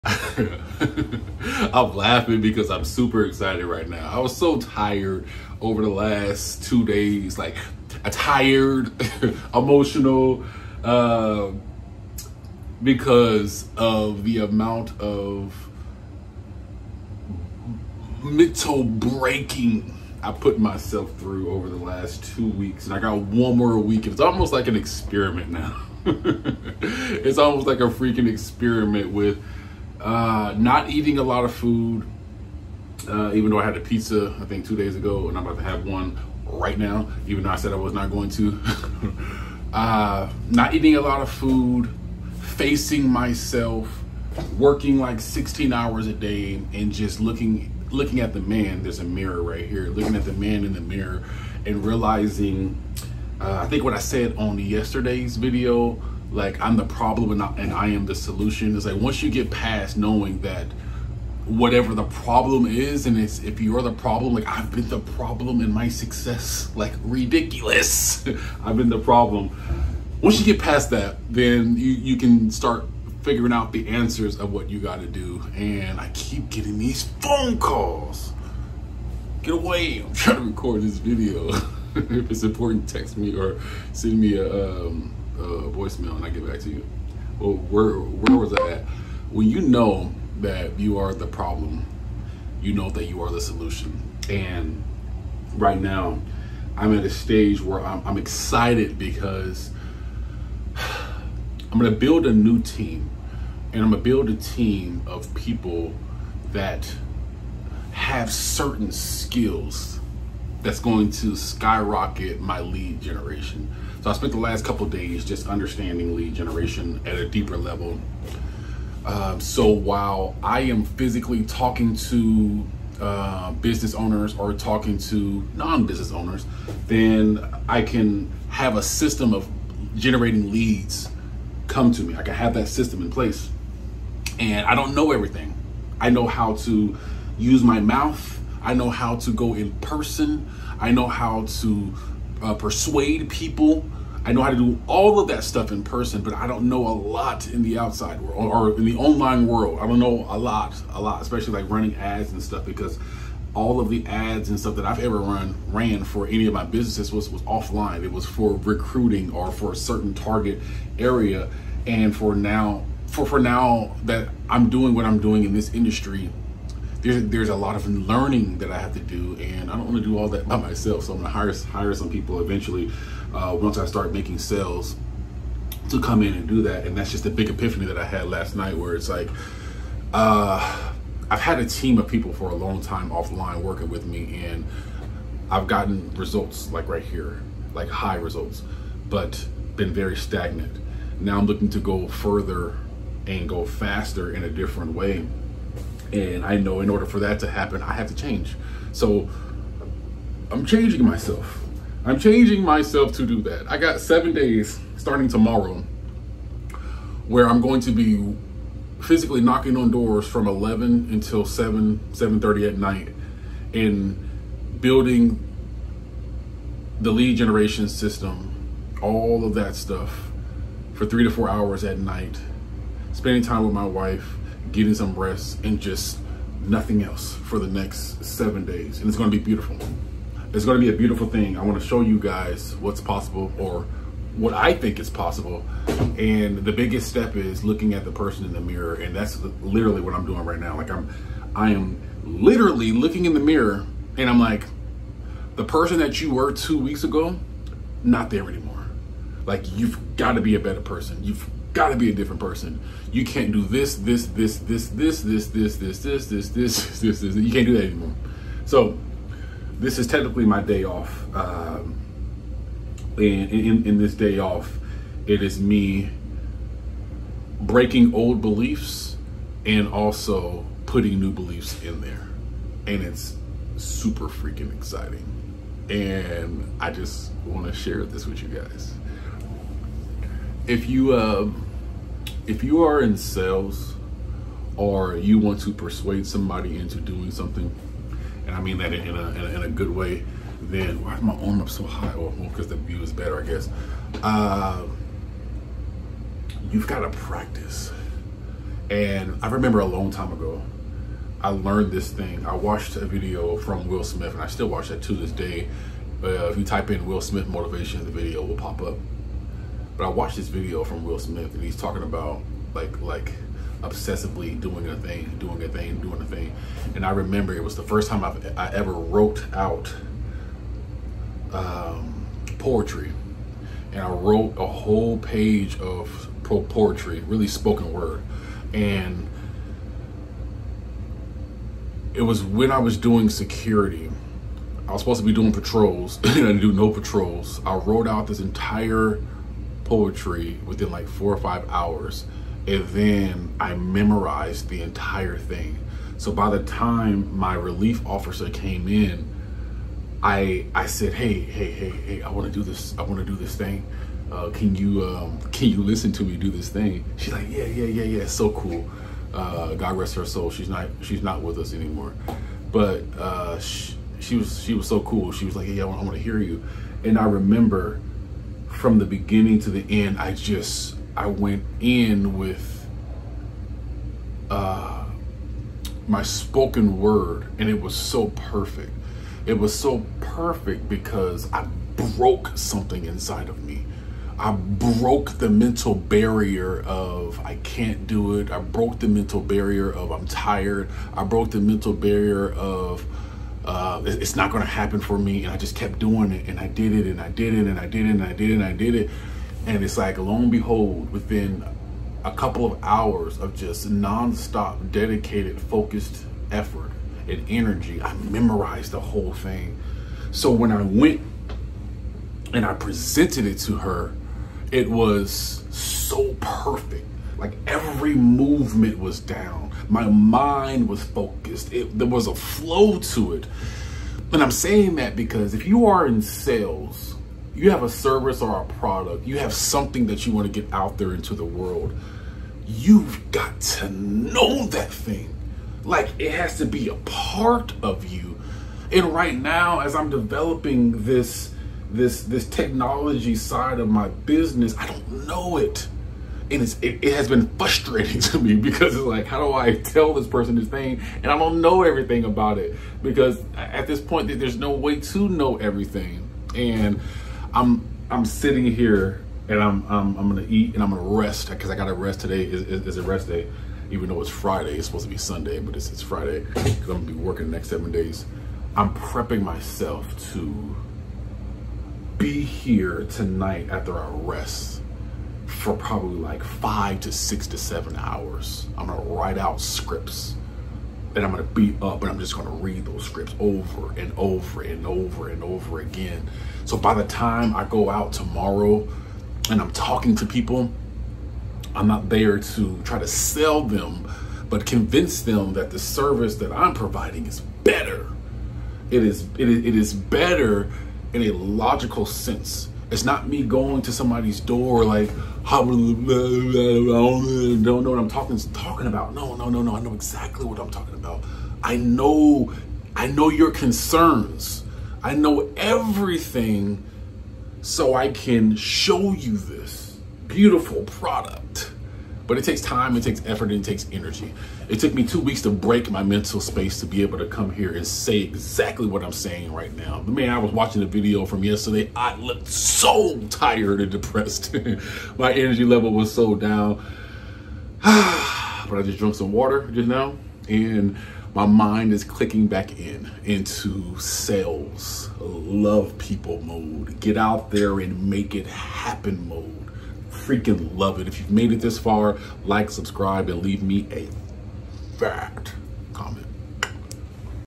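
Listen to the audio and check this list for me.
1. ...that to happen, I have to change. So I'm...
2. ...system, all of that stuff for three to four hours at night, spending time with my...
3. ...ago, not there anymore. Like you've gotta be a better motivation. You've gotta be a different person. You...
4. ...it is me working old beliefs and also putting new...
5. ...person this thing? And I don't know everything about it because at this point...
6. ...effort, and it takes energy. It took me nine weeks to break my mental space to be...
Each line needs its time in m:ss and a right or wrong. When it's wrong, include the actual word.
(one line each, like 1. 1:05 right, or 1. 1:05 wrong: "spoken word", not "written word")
1. 3:17 right
2. 3:37 right
3. 4:07 wrong: "person", not "motivation"
4. 4:25 wrong: "breaking", not "working"
5. 7:30 right
6. 8:43 wrong: "two", not "nine".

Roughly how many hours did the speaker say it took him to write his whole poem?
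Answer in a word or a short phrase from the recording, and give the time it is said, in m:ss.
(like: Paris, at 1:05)
4 or 5, at 5:41.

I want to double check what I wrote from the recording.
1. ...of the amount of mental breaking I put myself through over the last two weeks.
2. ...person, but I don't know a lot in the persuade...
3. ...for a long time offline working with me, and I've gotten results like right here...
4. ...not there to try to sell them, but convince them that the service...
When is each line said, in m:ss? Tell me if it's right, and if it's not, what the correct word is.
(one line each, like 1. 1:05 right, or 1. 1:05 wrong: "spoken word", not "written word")
1. 0:13 right
2. 2:25 wrong: "outside", not "persuade"
3. 3:02 right
4. 8:11 right.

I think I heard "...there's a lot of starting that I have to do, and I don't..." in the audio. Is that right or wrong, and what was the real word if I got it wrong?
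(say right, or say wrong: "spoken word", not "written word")
wrong: "learning", not "starting".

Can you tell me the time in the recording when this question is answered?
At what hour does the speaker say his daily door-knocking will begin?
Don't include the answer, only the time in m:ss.
3:30.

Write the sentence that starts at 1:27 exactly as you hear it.
Well, where where was I at?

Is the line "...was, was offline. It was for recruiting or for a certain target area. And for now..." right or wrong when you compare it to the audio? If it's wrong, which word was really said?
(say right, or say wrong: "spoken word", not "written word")
right.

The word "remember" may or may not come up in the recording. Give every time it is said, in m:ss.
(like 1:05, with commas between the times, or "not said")
4:59, 5:17, 6:07.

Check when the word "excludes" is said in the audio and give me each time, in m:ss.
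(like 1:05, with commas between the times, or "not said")
not said.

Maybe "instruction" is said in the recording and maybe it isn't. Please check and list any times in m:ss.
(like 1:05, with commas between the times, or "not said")
not said.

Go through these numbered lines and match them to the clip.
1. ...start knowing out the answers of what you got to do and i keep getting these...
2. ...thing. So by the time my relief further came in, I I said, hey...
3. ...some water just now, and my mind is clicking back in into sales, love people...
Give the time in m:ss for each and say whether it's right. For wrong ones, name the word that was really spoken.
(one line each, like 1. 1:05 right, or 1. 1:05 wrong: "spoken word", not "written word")
1. 1:12 wrong: "figuring", not "knowing"
2. 5:45 wrong: "officer", not "further"
3. 8:59 right.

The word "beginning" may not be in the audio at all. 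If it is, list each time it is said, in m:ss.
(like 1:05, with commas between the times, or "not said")
6:09.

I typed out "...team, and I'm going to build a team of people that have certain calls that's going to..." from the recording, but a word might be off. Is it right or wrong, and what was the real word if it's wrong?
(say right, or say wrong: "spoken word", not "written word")
wrong: "skills", not "calls".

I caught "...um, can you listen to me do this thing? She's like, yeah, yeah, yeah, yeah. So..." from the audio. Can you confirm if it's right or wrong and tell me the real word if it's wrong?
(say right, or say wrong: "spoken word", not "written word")
right.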